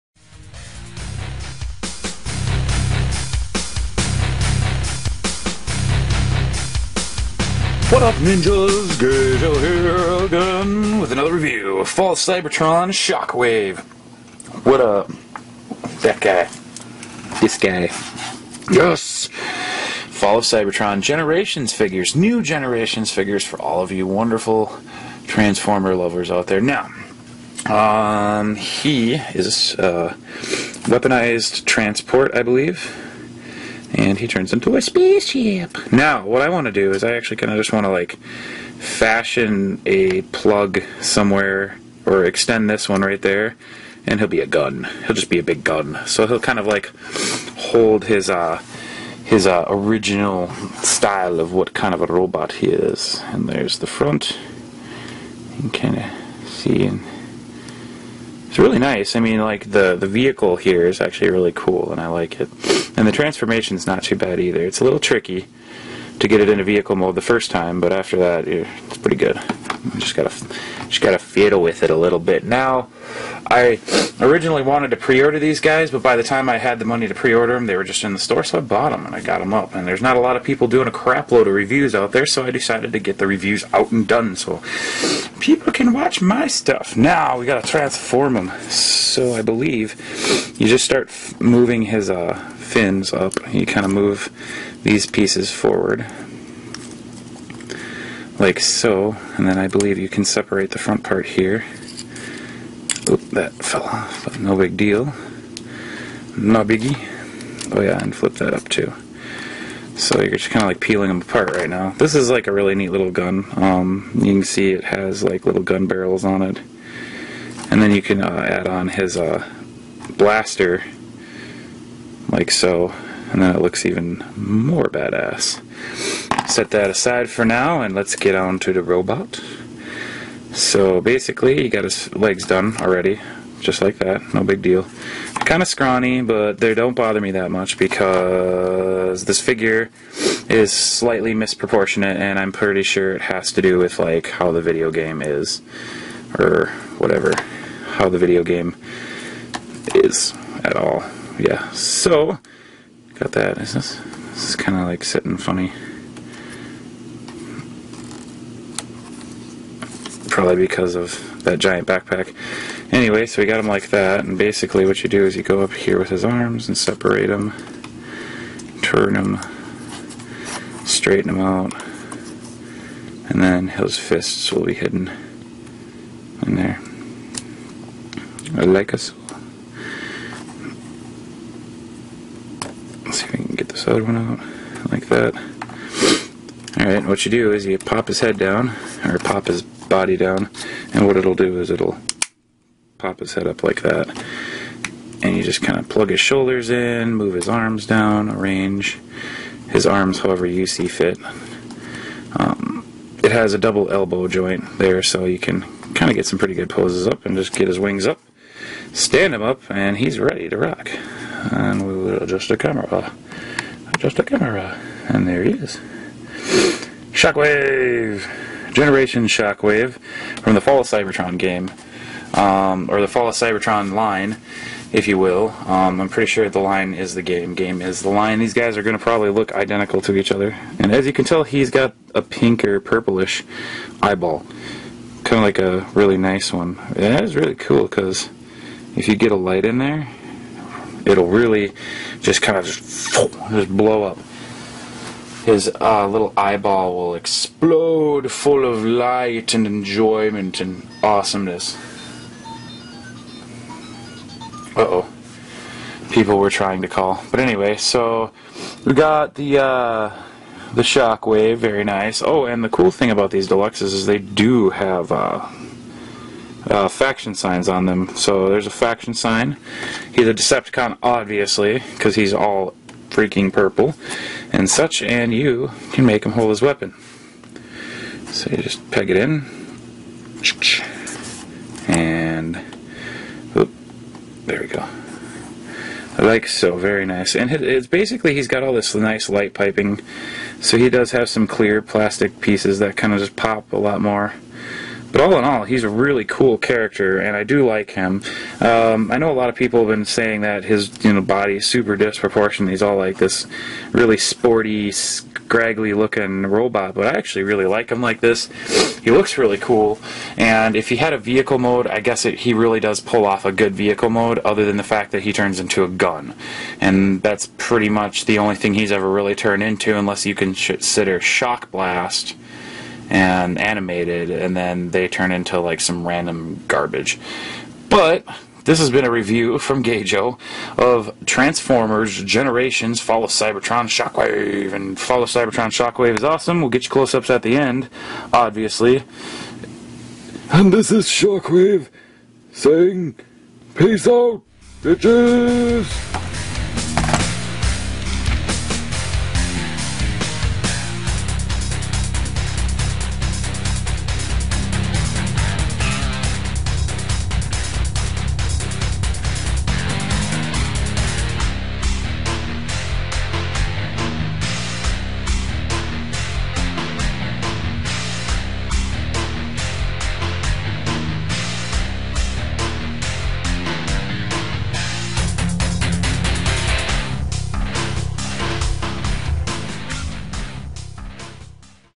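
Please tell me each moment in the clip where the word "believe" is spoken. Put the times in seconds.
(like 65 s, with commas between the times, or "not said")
32 s, 89 s, 99 s.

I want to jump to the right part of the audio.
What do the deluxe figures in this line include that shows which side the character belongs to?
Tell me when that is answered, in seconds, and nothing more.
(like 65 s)
266 s.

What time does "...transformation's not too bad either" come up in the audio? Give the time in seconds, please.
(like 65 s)
63 s.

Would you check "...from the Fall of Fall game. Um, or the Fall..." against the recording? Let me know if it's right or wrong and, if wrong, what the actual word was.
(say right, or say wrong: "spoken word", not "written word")
wrong: "Cybertron", not "Fall".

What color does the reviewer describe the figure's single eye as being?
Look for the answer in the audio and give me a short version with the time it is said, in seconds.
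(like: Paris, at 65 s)
Pink or purplish, at 232 s.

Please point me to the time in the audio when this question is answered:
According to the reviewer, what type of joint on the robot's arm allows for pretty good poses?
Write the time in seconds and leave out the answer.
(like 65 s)
203 s.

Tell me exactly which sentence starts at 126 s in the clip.
Set that aside for now and let's get on to the robot.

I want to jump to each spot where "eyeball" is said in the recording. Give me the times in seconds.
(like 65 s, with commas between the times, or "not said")
234 s, 246 s.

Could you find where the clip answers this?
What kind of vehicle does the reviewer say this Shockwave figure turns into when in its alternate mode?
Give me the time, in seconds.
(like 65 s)
34 s.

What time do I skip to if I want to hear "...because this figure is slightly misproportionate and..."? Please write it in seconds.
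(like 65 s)
137 s.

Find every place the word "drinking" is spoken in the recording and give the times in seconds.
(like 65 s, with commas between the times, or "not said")
not said.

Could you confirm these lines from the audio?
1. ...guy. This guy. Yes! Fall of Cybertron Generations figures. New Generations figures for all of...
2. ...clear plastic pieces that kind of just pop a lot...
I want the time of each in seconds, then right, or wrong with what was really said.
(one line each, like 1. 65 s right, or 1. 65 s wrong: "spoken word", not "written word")
1. 16 s right
2. 291 s right.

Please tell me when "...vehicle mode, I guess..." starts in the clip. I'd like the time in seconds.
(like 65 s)
311 s.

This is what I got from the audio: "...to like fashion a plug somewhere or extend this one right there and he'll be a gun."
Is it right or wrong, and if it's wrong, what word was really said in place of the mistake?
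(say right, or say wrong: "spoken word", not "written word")
right.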